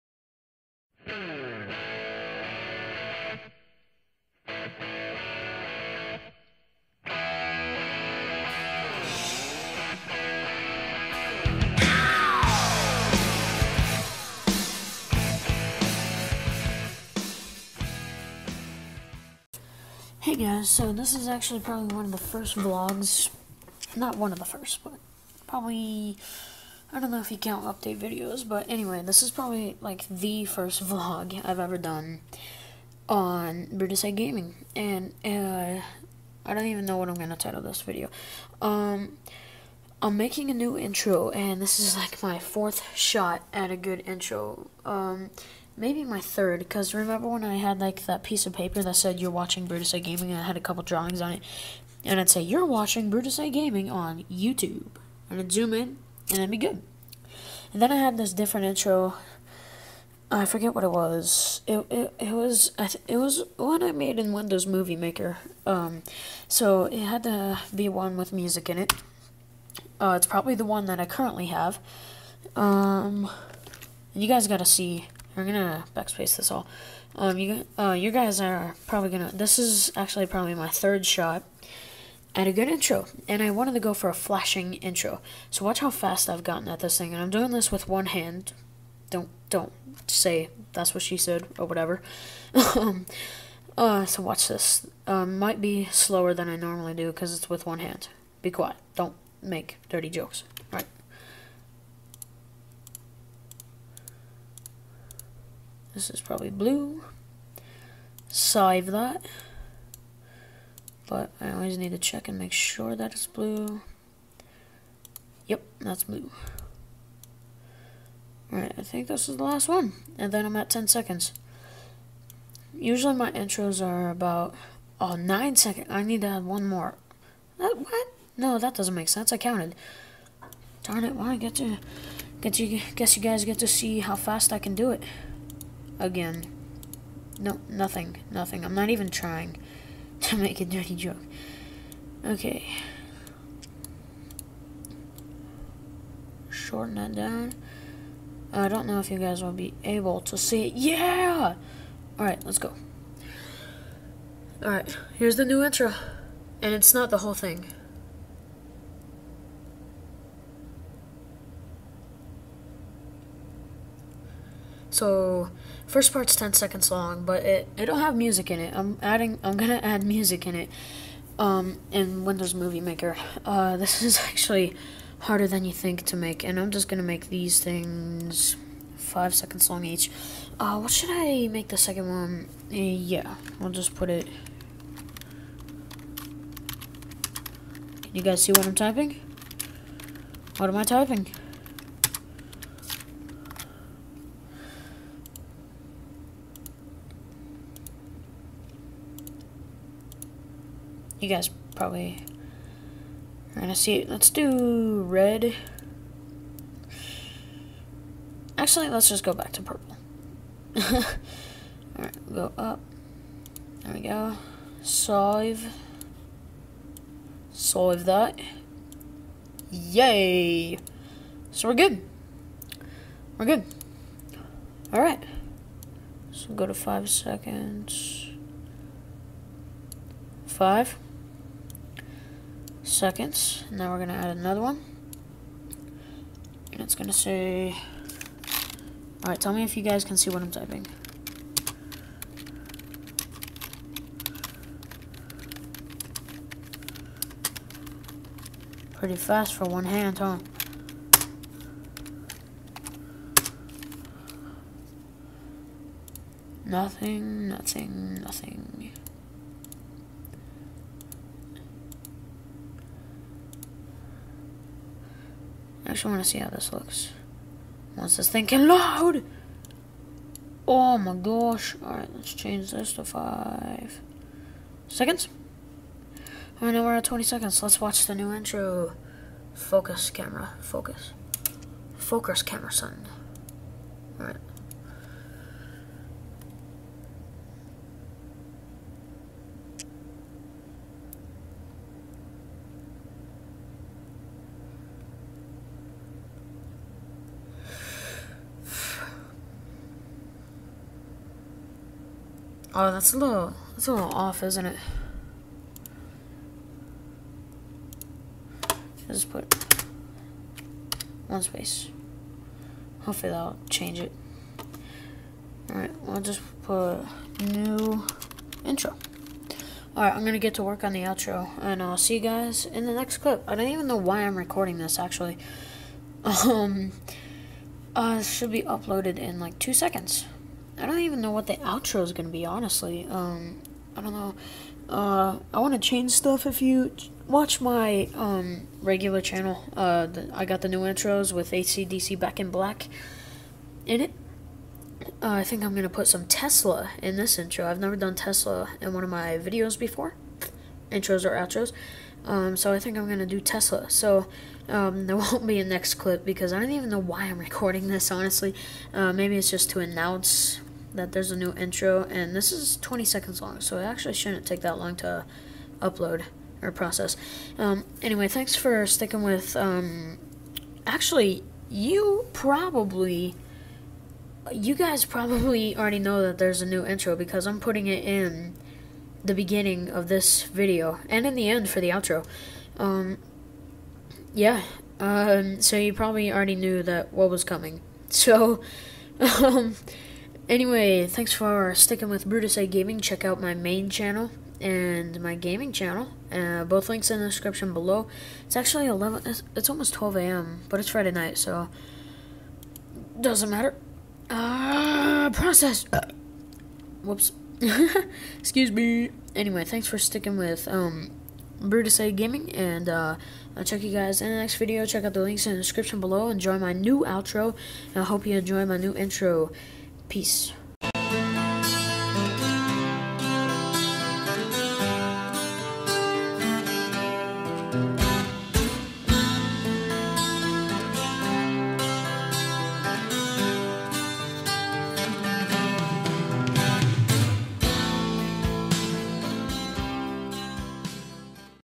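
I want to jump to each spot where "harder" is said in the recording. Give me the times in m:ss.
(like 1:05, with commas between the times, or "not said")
2:55.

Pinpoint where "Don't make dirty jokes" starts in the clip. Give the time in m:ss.
1:38.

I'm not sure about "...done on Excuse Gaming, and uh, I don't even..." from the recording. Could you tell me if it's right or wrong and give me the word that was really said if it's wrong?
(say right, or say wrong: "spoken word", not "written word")
wrong: "Brutusite", not "Excuse".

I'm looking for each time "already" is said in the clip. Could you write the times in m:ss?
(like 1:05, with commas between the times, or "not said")
6:15, 6:26.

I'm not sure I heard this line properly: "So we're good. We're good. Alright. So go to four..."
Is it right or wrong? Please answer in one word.
wrong.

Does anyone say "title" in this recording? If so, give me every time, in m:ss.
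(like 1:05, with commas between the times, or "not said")
0:37.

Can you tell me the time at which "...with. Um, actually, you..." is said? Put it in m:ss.
6:09.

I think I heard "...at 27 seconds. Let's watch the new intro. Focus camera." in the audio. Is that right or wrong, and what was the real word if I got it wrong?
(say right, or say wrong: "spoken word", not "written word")
wrong: "20", not "27".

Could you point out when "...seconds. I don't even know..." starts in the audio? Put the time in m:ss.
5:29.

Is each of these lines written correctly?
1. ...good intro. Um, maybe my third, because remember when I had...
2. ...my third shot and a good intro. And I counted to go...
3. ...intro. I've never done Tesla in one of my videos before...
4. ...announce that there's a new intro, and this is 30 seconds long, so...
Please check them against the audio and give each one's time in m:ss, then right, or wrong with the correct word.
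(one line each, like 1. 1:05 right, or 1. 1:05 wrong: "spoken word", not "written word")
1. 0:43 right
2. 1:20 wrong: "wanted", not "counted"
3. 5:47 right
4. 5:59 wrong: "20", not "30".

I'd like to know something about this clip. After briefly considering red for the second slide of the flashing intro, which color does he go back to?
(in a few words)
Purple.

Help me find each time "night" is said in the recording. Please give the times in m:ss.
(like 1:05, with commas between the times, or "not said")
6:41.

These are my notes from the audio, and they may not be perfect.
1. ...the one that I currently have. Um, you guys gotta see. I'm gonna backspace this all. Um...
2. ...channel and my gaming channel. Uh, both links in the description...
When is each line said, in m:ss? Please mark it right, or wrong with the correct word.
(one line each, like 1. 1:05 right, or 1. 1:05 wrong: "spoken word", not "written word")
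1. 1:10 right
2. 6:33 right.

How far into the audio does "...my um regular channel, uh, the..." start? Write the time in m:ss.
5:37.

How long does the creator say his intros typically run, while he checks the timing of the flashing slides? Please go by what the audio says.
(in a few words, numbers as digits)
9 seconds.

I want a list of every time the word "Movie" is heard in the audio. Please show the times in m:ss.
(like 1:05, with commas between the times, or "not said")
1:04, 2:52.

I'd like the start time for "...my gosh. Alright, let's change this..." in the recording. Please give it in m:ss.
4:30.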